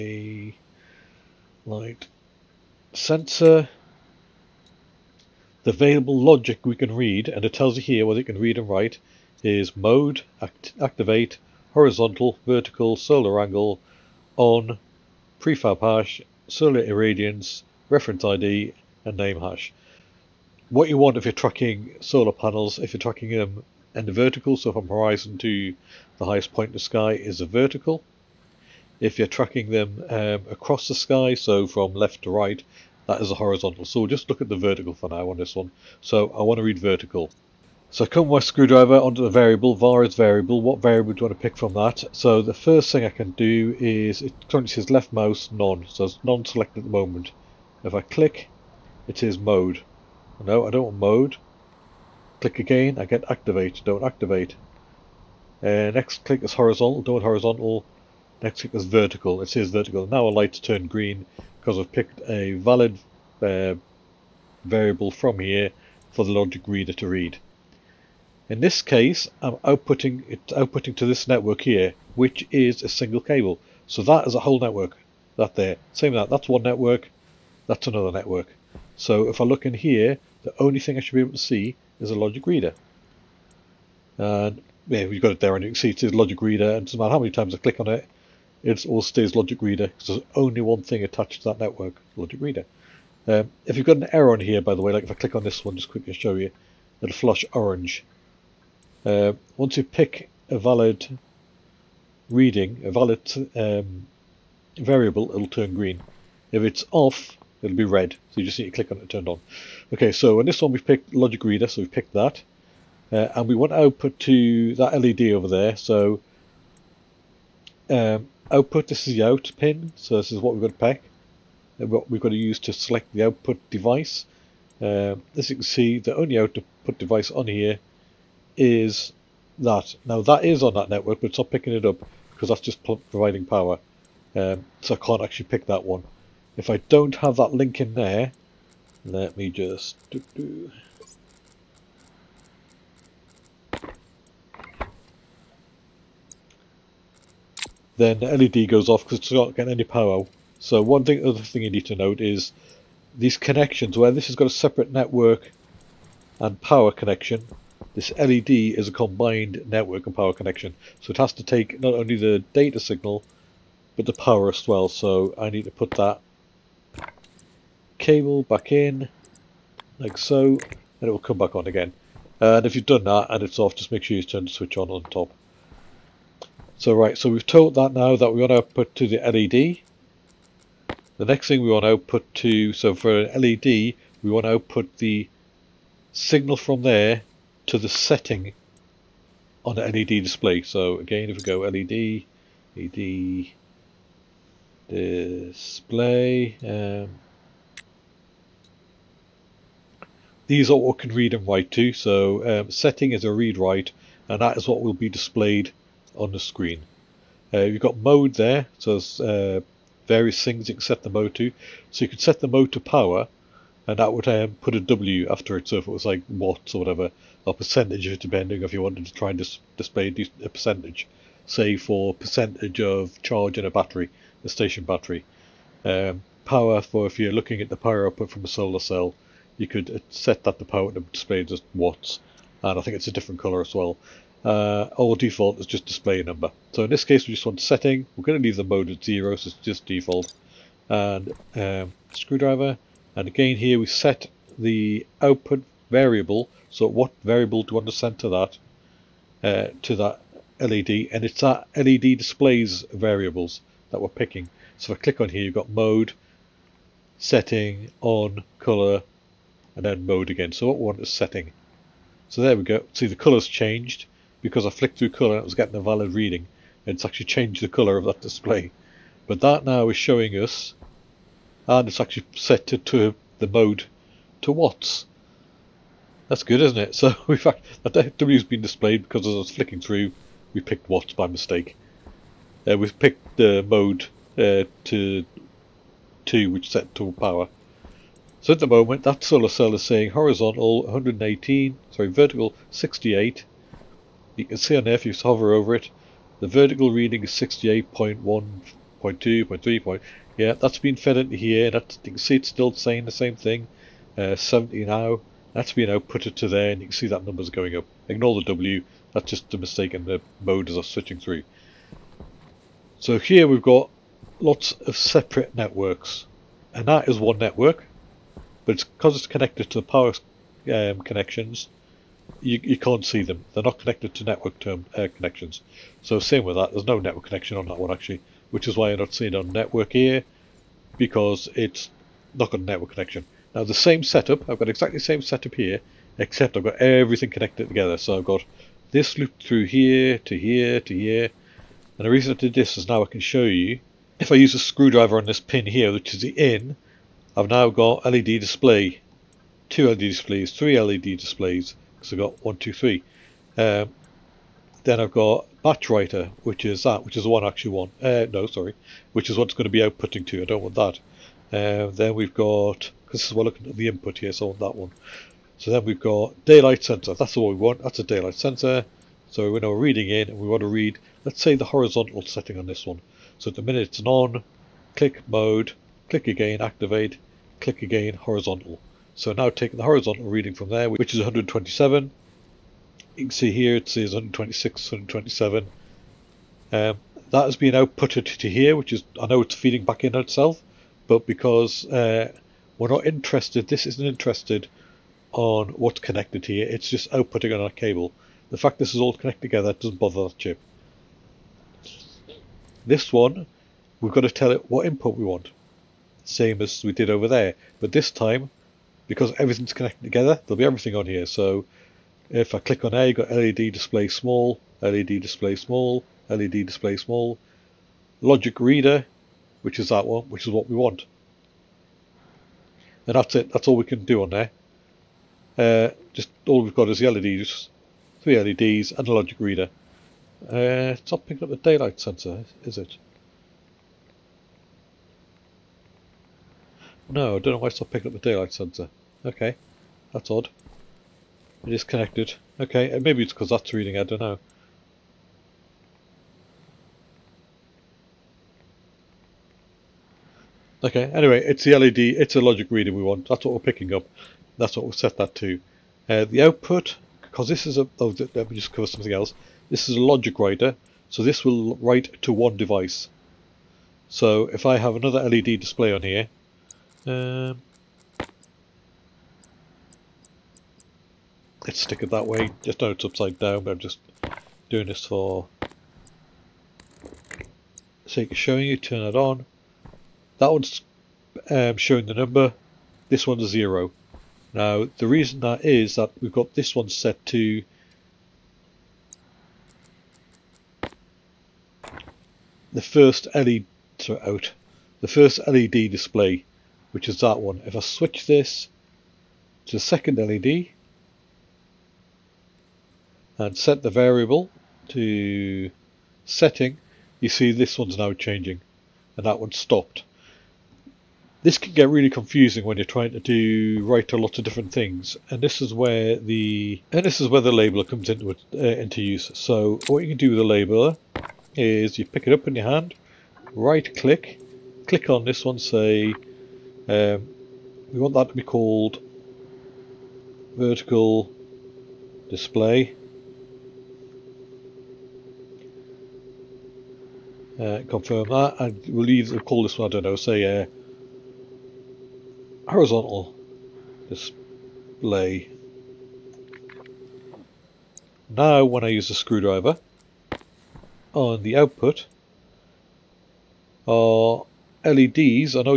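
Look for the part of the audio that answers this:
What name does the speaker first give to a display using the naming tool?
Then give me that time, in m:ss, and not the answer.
8:50.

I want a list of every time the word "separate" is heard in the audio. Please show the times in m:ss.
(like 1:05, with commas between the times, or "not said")
2:34, 5:14.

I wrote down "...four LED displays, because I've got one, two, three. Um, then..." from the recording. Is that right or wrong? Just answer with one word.
wrong.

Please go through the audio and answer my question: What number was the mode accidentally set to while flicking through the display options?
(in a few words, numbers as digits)
2.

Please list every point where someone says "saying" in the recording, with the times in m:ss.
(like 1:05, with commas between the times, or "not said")
4:49, 5:02.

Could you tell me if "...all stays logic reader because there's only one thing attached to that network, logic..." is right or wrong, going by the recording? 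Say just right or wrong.
right.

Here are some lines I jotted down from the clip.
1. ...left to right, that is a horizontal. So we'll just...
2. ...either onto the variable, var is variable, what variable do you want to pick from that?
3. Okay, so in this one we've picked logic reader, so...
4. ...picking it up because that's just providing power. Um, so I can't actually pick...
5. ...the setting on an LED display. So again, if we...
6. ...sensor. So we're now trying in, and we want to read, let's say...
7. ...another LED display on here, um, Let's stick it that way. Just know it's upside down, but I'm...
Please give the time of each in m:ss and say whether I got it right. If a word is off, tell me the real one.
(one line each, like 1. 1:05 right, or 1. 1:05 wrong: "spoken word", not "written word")
1. 0:31 right
2. 0:38 wrong: "screwdriver", not "either"
3. 1:49 right
4. 2:11 right
5. 3:07 right
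6. 6:08 wrong: "reading", not "trying"
7. 7:44 right.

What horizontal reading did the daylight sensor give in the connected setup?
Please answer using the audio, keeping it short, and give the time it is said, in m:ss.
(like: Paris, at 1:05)
127, at 6:20.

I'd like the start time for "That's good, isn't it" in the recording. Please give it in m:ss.
4:36.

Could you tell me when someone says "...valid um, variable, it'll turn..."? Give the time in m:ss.
1:42.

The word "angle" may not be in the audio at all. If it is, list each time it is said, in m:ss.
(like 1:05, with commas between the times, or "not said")
0:13.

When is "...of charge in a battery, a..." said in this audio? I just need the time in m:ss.
3:42.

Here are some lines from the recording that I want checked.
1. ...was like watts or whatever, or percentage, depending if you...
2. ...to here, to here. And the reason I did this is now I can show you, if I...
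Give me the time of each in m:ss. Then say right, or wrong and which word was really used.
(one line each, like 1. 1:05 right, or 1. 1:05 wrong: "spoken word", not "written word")
1. 3:35 right
2. 5:40 right.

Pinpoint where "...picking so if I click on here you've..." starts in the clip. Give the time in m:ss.
4:14.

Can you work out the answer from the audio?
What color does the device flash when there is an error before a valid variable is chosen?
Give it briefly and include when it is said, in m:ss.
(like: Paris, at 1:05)
orange, at 1:37.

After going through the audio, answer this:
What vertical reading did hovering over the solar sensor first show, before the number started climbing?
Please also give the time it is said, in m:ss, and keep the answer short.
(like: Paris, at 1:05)
68.1, at 4:57.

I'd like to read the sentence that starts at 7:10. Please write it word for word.
Uh, it's not picking up the daylight sensor, is it?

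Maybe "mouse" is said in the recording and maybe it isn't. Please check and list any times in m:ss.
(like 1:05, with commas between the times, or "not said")
0:45.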